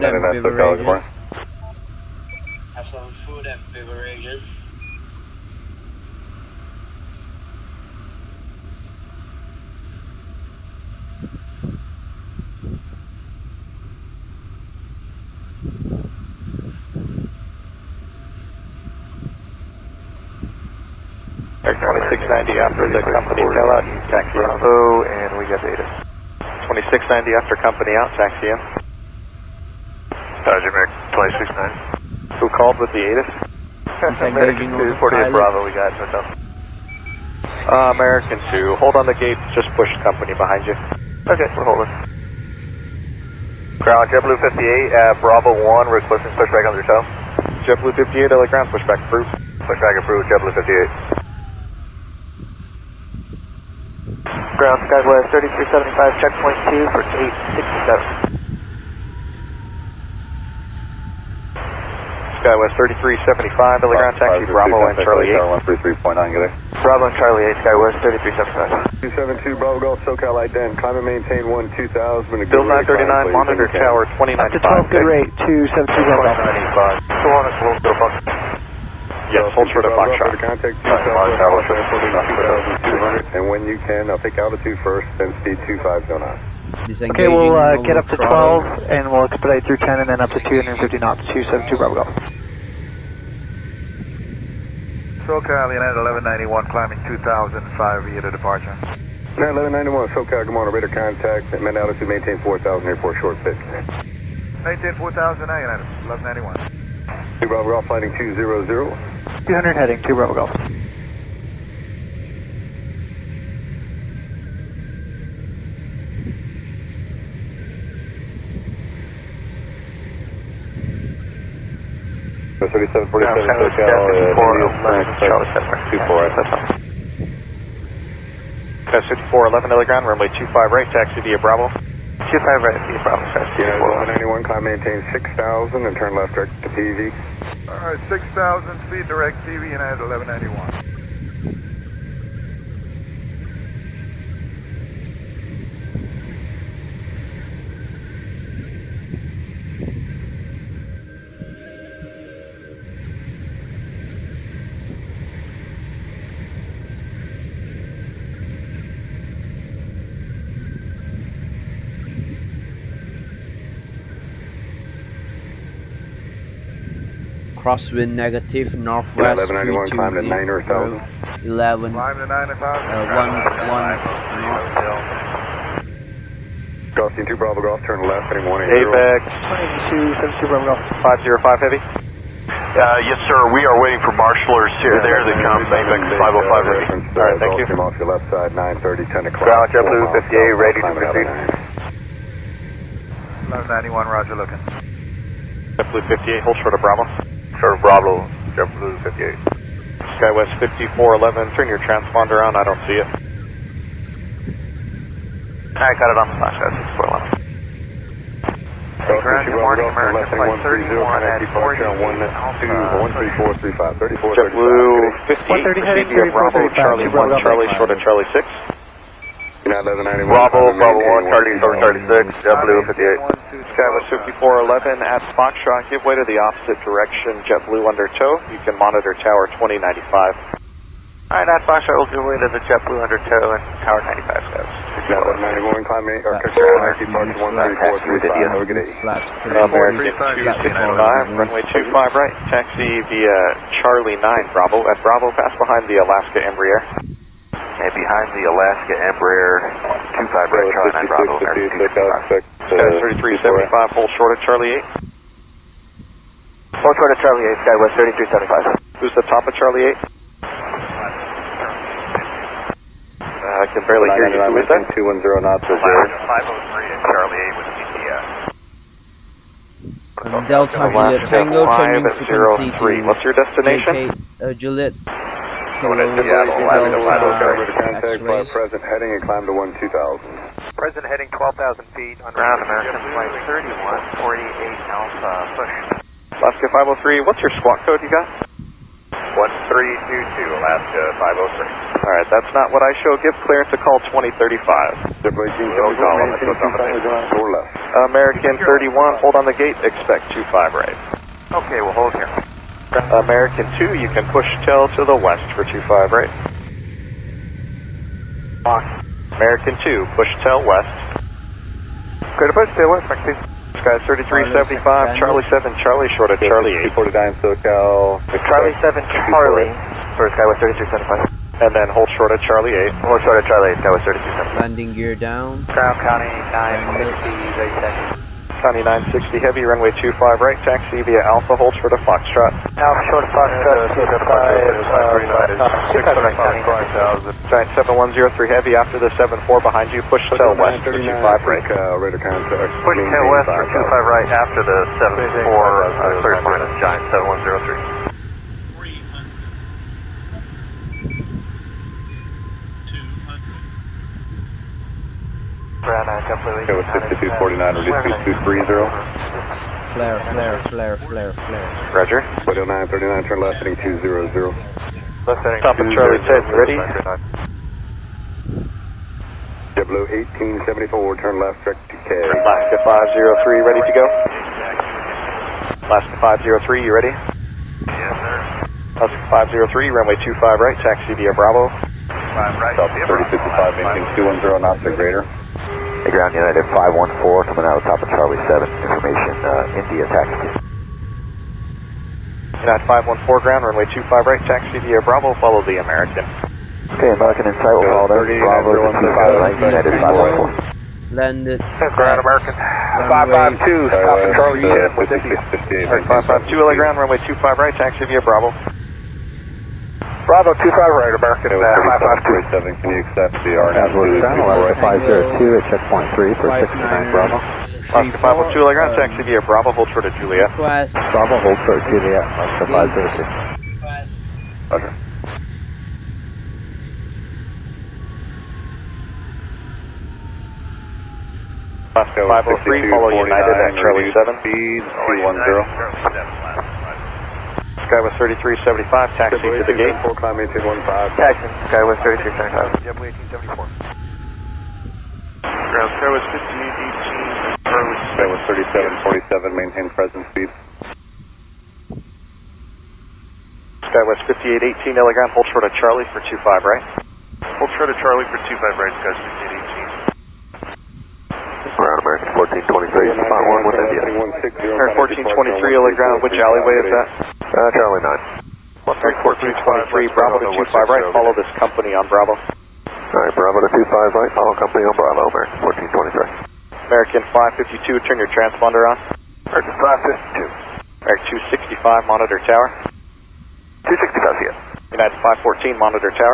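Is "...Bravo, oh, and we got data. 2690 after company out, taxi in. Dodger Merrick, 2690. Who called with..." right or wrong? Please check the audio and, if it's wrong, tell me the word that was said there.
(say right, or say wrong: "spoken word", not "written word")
right.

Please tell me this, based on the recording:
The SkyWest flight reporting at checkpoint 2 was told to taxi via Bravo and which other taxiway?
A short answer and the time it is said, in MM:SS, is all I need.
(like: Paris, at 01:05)
Charlie 8, at 01:04.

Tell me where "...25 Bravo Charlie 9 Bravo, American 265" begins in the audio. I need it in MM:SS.
04:10.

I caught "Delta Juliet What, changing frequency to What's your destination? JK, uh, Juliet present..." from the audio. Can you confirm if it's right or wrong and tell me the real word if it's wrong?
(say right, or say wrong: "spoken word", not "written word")
wrong: "Tango", not "What".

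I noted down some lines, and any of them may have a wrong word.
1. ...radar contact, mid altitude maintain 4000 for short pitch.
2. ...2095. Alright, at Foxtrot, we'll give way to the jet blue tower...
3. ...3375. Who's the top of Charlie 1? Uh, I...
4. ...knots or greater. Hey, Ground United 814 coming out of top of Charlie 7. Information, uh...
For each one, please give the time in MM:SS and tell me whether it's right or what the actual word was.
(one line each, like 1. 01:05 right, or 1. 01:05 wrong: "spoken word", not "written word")
1. 01:40 right
2. 03:49 wrong: "under", not "tower"
3. 04:17 wrong: "8", not "1"
4. 06:24 wrong: "514", not "814".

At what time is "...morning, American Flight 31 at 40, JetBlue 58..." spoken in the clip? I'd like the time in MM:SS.
03:29.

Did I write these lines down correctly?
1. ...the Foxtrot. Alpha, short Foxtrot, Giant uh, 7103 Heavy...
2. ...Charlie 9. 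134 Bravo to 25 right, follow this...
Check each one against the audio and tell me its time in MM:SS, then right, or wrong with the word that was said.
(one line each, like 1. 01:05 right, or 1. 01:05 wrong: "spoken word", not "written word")
1. 05:31 right
2. 07:47 right.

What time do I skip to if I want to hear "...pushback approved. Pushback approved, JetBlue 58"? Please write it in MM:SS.
00:48.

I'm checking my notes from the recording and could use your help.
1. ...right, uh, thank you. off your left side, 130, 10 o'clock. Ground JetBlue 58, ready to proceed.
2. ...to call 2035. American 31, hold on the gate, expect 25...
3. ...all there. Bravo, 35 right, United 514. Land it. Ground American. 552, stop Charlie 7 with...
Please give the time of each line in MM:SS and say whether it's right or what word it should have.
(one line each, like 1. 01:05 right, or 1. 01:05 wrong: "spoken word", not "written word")
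1. 03:07 wrong: "930", not "130"
2. 04:53 right
3. 06:37 wrong: "25", not "35".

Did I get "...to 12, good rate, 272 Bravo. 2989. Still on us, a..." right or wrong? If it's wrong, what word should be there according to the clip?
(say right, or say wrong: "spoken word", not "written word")
wrong: "2985", not "2989".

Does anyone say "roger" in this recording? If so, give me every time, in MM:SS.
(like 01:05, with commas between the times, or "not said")
03:14, 06:01, 07:04.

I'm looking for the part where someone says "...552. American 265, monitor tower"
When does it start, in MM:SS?
07:59.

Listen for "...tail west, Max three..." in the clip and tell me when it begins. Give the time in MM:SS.
05:12.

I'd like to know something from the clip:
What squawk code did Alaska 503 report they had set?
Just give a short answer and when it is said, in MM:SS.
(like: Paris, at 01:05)
1322, at 04:49.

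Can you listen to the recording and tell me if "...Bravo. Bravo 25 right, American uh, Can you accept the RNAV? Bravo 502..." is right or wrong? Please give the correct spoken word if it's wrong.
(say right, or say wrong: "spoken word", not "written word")
right.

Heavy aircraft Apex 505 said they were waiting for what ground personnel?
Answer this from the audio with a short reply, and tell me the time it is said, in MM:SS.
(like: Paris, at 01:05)
marshalers, at 03:04.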